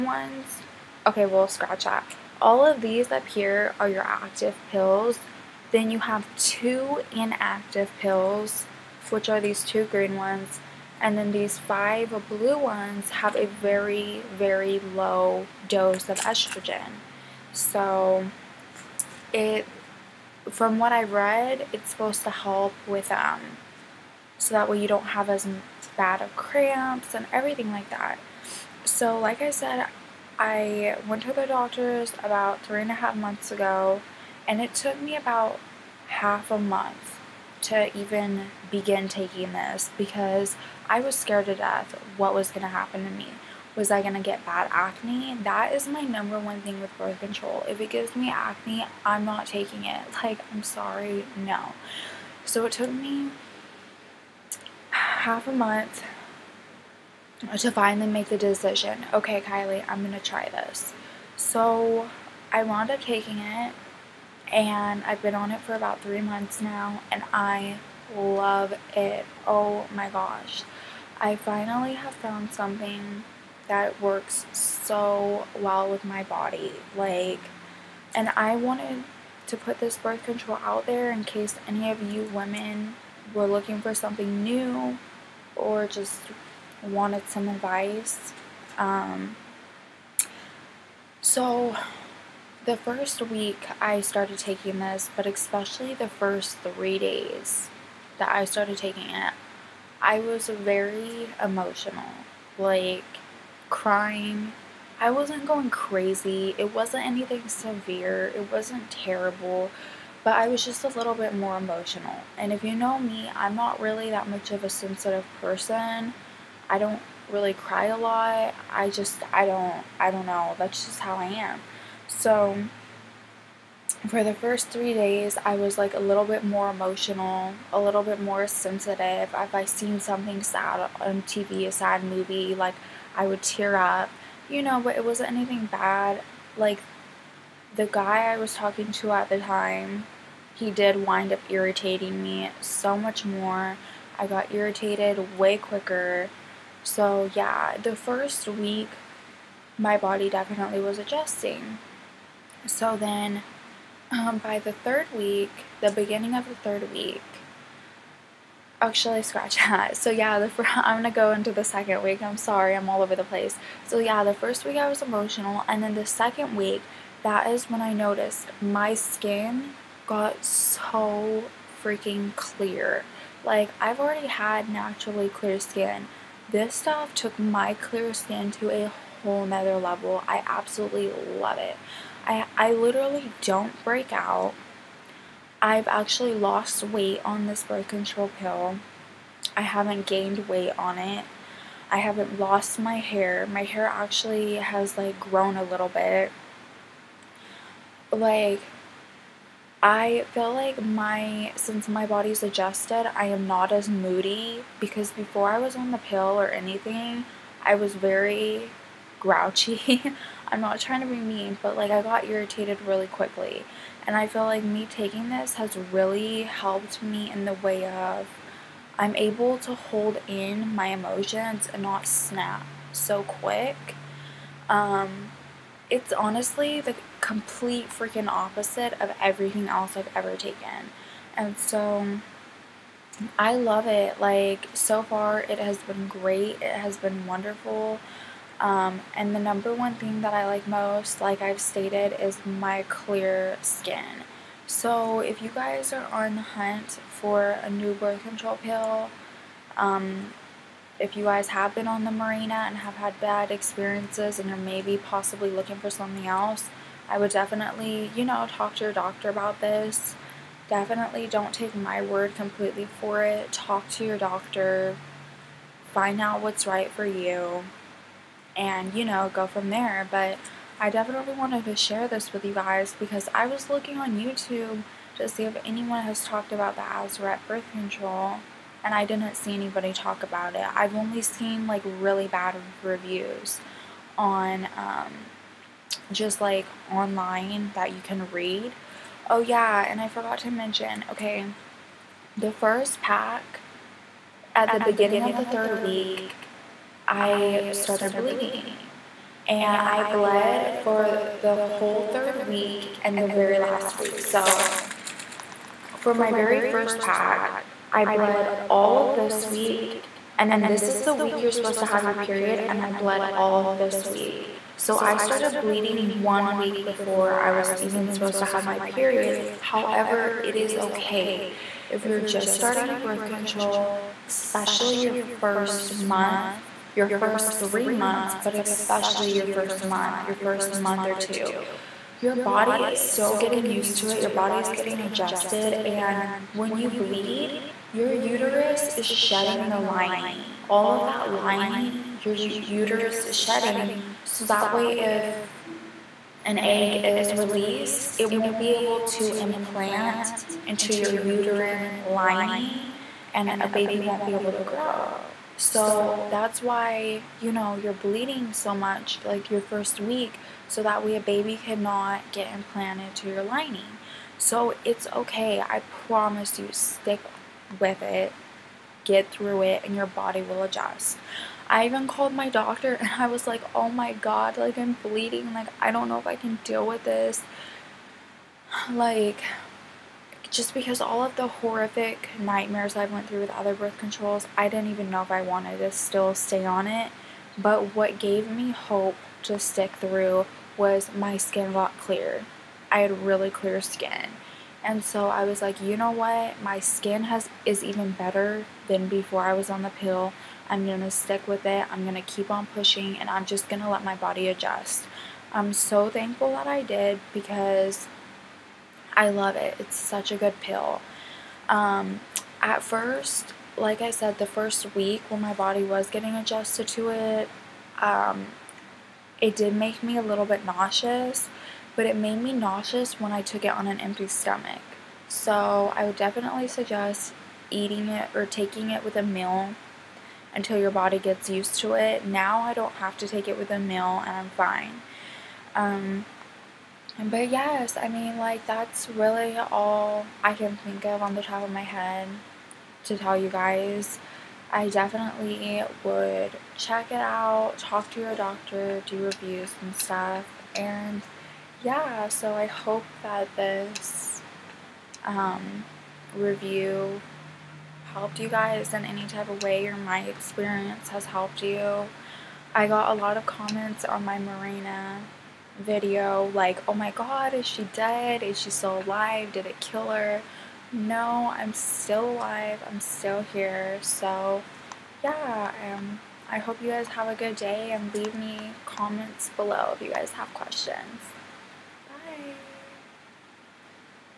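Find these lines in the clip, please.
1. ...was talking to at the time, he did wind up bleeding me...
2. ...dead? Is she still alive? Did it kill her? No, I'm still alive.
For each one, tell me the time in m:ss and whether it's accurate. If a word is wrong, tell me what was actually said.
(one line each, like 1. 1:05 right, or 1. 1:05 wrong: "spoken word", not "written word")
1. 2:18 wrong: "irritating", not "bleeding"
2. 7:47 right.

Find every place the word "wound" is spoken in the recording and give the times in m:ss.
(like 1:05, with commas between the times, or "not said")
1:02.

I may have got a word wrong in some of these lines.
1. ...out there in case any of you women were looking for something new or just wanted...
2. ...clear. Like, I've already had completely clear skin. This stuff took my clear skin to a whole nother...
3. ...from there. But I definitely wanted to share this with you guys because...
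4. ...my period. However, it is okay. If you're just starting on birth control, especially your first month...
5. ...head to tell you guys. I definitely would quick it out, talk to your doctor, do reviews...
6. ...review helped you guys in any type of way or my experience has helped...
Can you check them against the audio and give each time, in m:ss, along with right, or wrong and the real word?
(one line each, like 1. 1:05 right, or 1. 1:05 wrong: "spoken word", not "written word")
1. 1:20 right
2. 2:52 wrong: "naturally", not "completely"
3. 4:29 right
4. 5:18 right
5. 7:21 wrong: "check", not "quick"
6. 7:36 right.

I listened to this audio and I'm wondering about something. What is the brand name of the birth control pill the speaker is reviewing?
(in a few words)
Azurette.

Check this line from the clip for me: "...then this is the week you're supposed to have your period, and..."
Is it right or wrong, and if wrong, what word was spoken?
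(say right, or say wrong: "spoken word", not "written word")
right.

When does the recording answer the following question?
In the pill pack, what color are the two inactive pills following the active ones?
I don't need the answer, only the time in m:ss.
0:09.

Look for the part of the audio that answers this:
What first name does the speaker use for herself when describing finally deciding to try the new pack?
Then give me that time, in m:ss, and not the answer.
0:59.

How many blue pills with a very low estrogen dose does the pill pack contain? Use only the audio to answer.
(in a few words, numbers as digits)
5.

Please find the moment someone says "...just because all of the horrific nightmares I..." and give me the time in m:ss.
6:20.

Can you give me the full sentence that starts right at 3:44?
Um, it's honestly the complete freaking opposite of everything else I've ever taken.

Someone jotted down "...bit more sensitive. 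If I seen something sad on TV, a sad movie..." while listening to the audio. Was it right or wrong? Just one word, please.
right.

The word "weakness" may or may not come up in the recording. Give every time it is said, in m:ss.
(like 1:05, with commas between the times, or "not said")
not said.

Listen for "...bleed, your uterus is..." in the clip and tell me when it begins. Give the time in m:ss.
5:36.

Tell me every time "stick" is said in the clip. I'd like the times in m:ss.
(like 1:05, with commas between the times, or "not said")
6:06, 6:29, 6:41.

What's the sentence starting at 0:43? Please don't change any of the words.
Was I going to get bad acne?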